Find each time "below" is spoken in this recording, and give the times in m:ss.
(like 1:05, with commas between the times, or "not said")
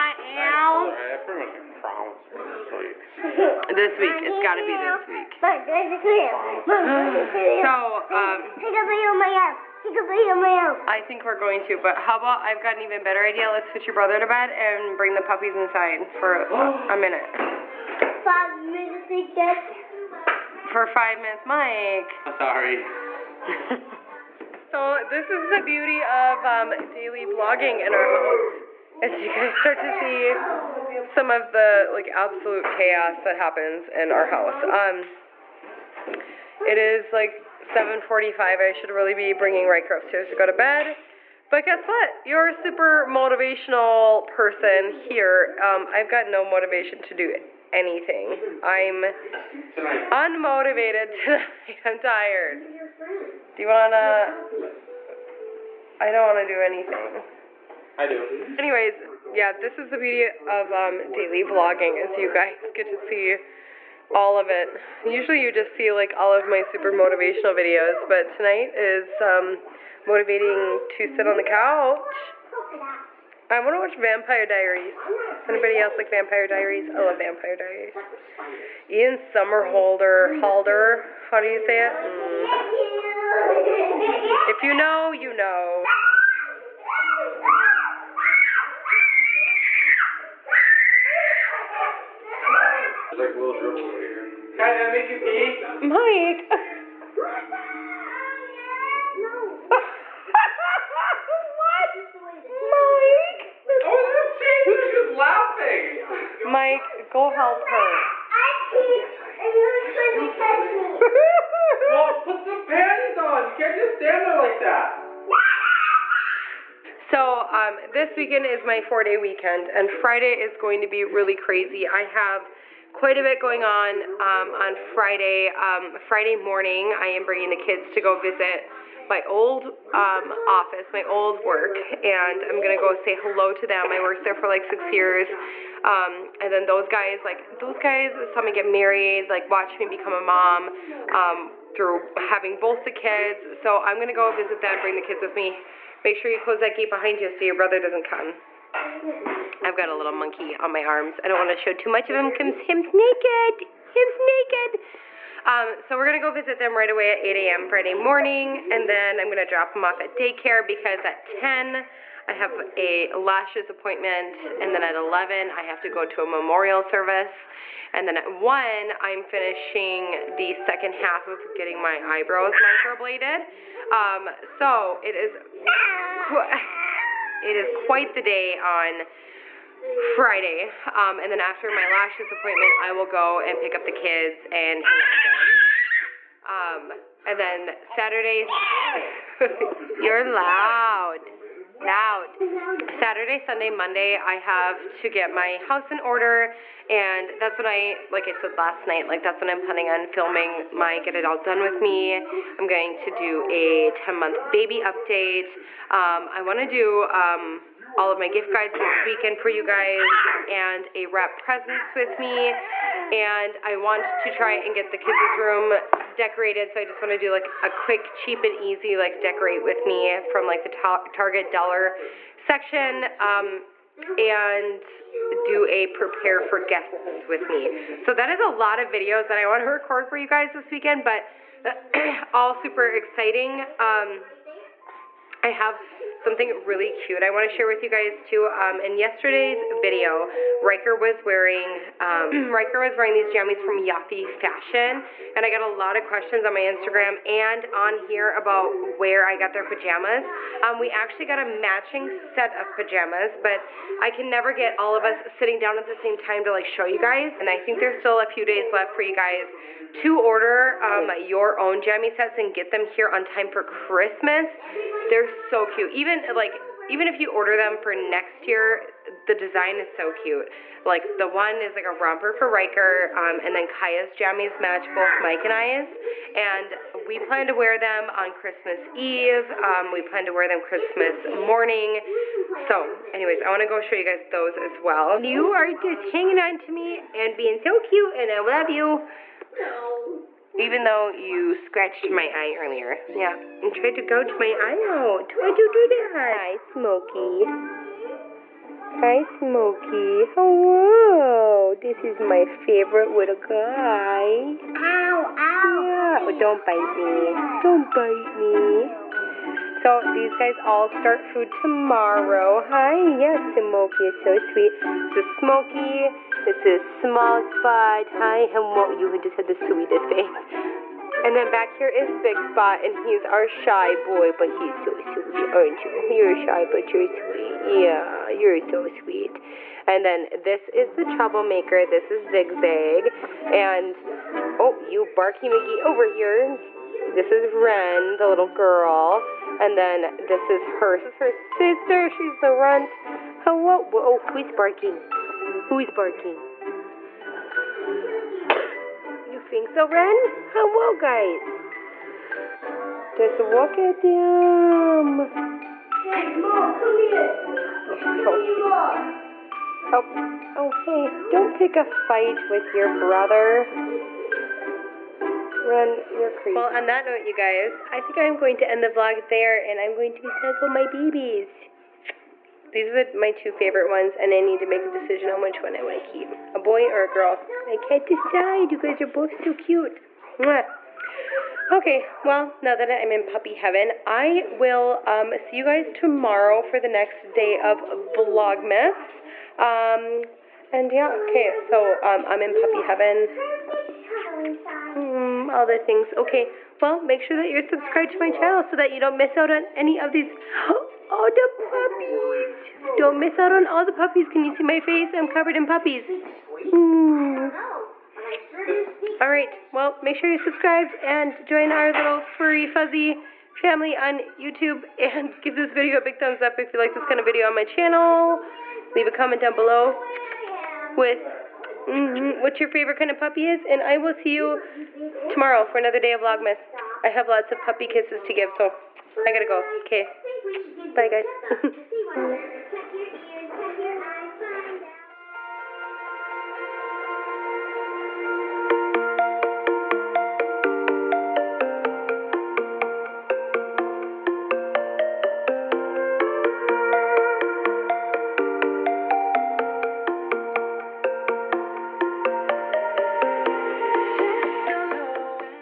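6:59.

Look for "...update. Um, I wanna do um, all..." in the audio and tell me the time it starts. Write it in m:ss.
3:24.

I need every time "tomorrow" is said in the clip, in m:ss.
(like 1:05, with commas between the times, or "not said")
5:11, 6:25, 7:05.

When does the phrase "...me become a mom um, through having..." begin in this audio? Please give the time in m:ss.
2:19.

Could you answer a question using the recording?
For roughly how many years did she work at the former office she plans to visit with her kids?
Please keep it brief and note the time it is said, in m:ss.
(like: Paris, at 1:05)
6, at 2:13.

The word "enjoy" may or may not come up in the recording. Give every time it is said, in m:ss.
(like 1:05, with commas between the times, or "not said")
not said.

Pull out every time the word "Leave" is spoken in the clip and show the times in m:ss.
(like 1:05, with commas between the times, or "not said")
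6:58.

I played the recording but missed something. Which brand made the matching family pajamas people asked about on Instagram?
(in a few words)
Yaffe Fashion.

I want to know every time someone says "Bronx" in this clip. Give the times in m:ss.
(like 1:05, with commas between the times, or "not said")
not said.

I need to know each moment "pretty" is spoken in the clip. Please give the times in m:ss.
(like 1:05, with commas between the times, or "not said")
0:01.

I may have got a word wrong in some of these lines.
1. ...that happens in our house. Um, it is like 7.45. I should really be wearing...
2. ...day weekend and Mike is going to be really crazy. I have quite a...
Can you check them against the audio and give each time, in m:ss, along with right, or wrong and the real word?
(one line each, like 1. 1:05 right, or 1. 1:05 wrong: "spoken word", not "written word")
1. 0:33 wrong: "bringing", not "wearing"
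2. 1:59 wrong: "Friday", not "Mike".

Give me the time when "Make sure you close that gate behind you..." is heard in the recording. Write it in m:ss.
2:26.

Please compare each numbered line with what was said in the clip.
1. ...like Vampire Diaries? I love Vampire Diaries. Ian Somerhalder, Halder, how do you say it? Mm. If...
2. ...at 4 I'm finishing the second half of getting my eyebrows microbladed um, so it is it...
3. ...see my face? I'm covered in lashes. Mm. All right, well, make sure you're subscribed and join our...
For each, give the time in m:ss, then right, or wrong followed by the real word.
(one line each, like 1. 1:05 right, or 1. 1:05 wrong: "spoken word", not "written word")
1. 1:15 right
2. 2:48 wrong: "1", not "4"
3. 6:44 wrong: "puppies", not "lashes".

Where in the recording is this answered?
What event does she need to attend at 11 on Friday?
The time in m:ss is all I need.
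2:44.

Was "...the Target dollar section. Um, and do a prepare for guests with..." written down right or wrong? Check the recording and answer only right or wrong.
right.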